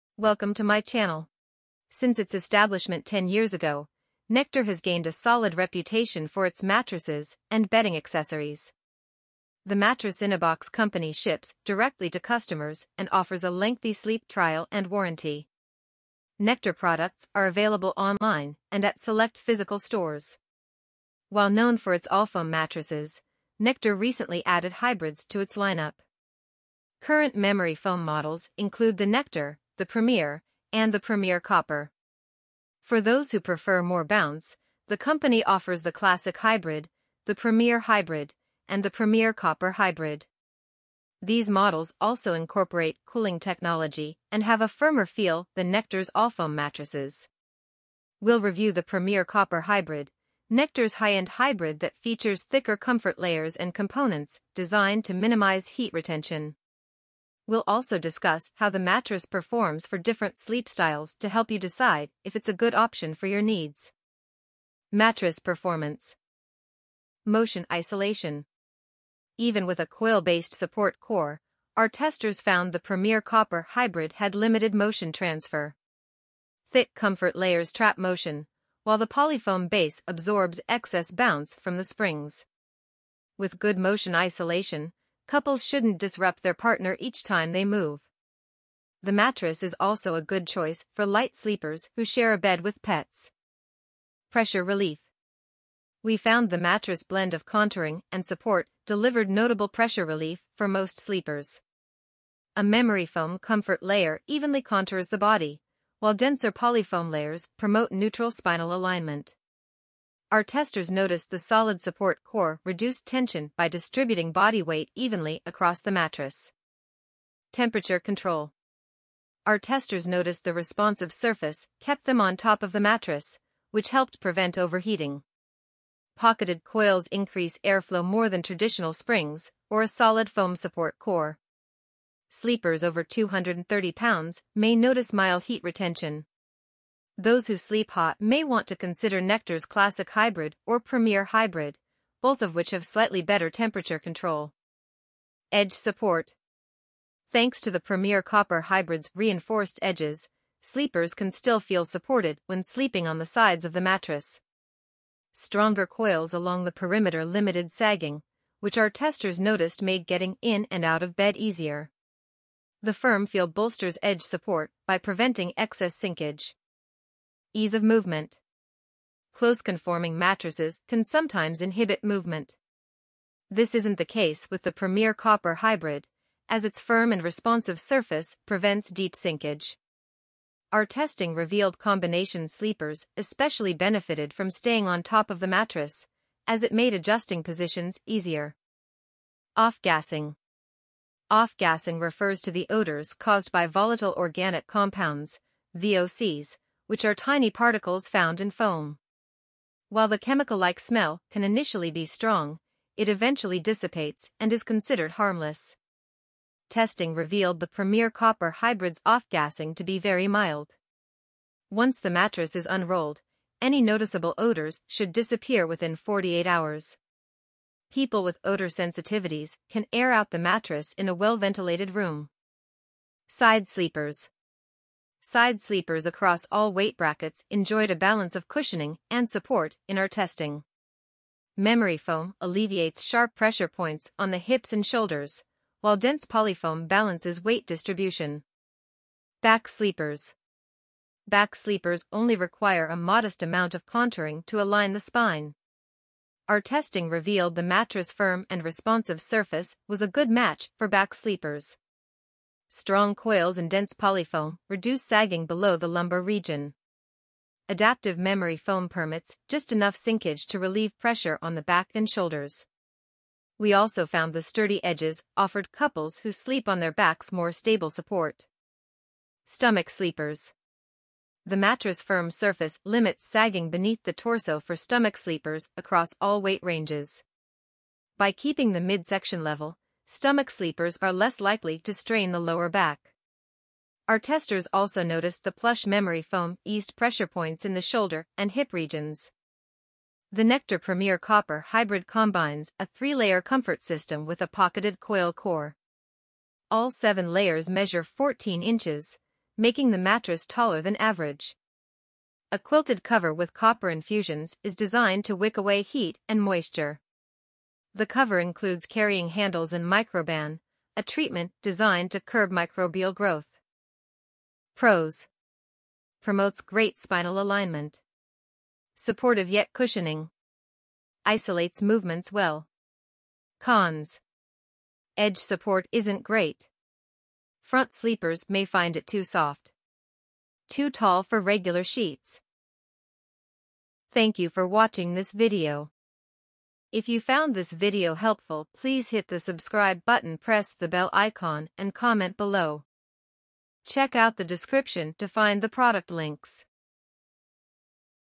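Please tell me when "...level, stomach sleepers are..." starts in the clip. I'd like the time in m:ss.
4:39.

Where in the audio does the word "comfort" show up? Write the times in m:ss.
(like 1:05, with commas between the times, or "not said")
0:52, 1:16, 1:43, 4:53.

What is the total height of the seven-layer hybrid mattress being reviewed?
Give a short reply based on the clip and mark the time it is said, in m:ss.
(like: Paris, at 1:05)
14 inches, at 4:58.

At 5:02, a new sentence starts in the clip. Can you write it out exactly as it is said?
A quilted cover with copper infusions is designed to wick away heat and moisture.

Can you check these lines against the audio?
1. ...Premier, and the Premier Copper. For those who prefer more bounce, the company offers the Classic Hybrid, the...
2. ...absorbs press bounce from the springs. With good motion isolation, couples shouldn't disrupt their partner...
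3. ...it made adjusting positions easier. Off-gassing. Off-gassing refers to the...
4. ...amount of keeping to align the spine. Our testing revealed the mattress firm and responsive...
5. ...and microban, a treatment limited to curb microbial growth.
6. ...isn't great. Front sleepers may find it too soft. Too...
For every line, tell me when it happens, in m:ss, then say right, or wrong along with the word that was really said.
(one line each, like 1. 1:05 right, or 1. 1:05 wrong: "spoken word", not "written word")
1. 0:29 right
2. 1:20 wrong: "excess", not "press"
3. 3:06 right
4. 4:03 wrong: "contouring", not "keeping"
5. 5:09 wrong: "designed", not "limited"
6. 5:25 right.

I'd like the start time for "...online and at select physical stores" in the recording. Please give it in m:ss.
0:17.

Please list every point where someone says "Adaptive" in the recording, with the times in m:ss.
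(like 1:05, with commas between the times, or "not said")
4:17.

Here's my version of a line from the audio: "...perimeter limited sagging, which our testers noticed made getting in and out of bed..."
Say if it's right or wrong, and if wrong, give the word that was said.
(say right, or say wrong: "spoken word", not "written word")
right.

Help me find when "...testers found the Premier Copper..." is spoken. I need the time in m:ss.
1:11.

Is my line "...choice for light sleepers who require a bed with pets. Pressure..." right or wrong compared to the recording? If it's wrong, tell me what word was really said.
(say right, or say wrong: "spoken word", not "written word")
wrong: "share", not "require".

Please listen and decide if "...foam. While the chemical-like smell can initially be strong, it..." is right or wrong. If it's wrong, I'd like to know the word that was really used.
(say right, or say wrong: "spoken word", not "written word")
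right.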